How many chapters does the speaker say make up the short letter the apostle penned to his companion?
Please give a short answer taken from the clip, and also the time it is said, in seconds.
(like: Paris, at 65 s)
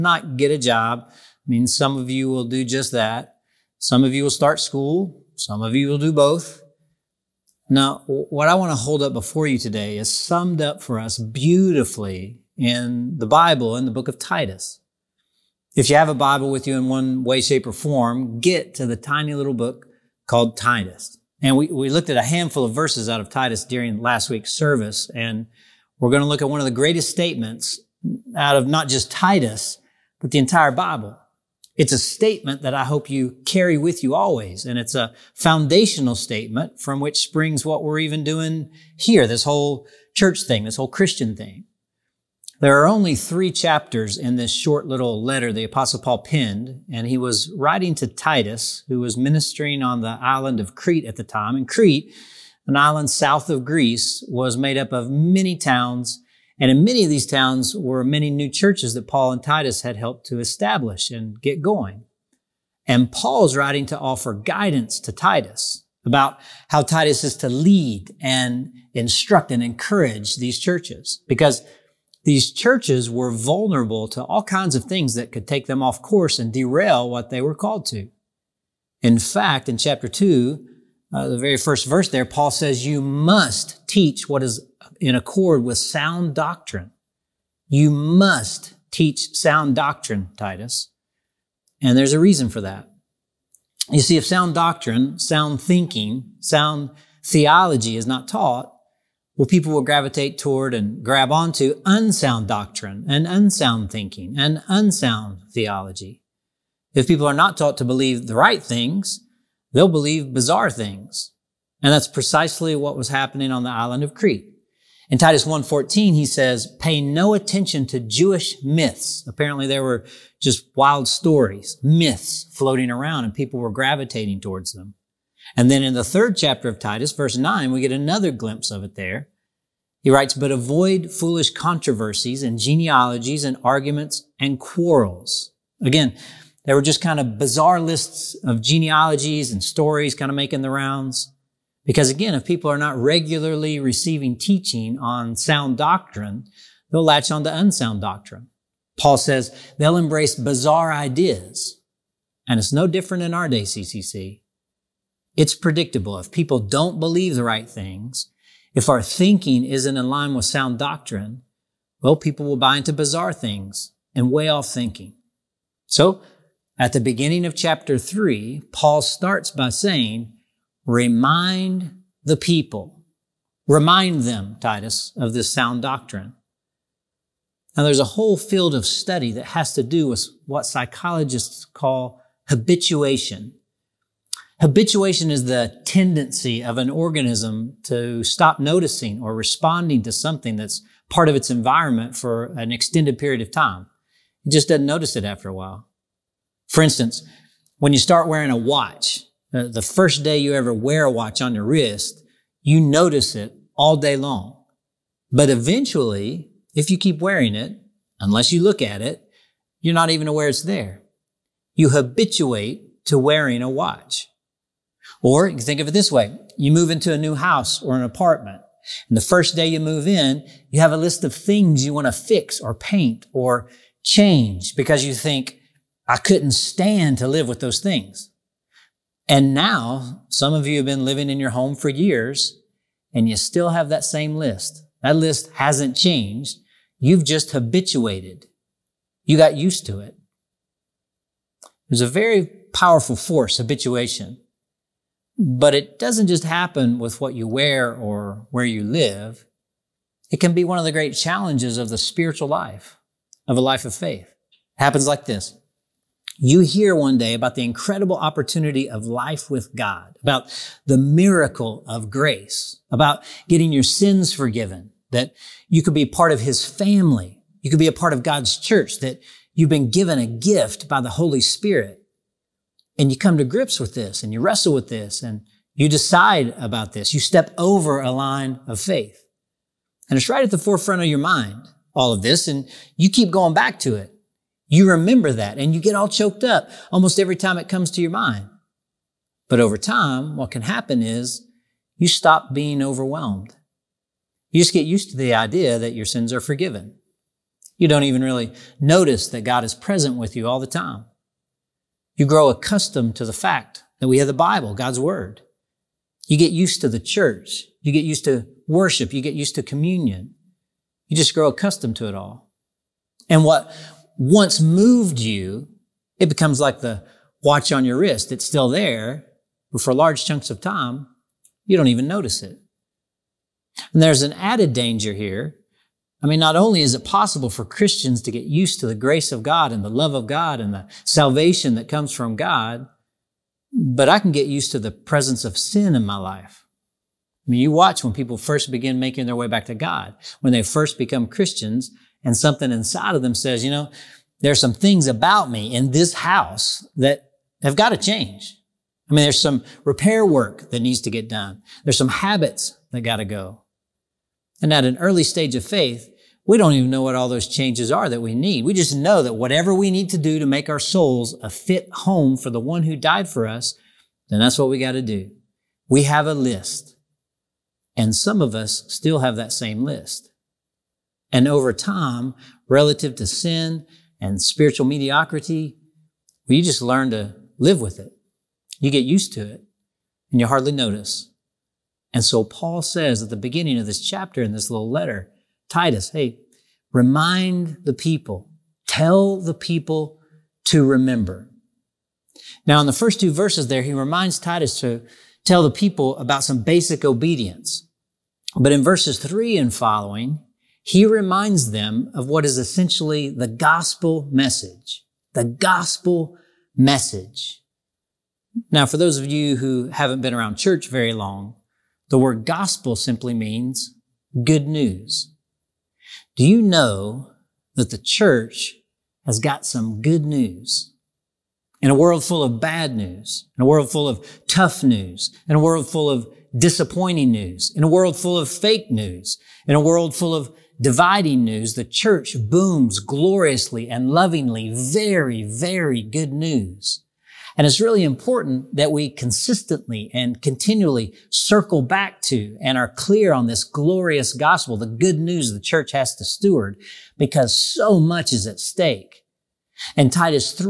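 3, at 43 s.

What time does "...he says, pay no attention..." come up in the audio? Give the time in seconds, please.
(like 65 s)
116 s.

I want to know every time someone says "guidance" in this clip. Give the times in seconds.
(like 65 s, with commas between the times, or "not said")
64 s.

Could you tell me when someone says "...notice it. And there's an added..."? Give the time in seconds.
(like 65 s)
322 s.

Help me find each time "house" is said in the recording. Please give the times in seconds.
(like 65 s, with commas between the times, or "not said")
217 s, 346 s.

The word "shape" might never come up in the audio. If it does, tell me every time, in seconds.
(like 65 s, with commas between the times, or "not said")
17 s.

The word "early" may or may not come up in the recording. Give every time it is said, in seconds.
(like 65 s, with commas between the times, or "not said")
354 s.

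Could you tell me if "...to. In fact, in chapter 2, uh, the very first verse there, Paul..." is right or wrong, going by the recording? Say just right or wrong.
right.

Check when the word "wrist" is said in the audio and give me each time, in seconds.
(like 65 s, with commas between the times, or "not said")
201 s, 317 s.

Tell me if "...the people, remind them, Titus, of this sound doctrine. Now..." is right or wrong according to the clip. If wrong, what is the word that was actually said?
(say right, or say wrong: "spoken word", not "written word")
right.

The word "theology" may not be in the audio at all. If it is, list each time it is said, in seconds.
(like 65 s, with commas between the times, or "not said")
97 s, 105 s.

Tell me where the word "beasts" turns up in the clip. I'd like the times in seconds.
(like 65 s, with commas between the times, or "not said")
not said.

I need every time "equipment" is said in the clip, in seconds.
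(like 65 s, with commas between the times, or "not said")
not said.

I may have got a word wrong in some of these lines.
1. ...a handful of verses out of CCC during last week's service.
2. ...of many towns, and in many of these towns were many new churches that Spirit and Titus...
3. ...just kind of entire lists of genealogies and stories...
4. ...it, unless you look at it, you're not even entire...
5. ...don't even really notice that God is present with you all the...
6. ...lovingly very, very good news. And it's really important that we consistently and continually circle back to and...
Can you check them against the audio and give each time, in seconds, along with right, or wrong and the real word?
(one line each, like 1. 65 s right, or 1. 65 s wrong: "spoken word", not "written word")
1. 22 s wrong: "Titus", not "CCC"
2. 54 s wrong: "Paul", not "Spirit"
3. 136 s wrong: "bizarre", not "entire"
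4. 207 s wrong: "aware", not "entire"
5. 297 s right
6. 434 s right.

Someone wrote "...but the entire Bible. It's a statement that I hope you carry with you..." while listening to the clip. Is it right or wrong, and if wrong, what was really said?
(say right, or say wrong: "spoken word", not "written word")
right.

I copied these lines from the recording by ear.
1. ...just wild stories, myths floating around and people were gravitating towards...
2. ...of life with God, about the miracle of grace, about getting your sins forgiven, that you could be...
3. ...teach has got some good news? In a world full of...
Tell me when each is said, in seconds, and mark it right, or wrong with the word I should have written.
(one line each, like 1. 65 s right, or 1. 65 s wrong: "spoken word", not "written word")
1. 120 s right
2. 258 s right
3. 417 s wrong: "church", not "teach".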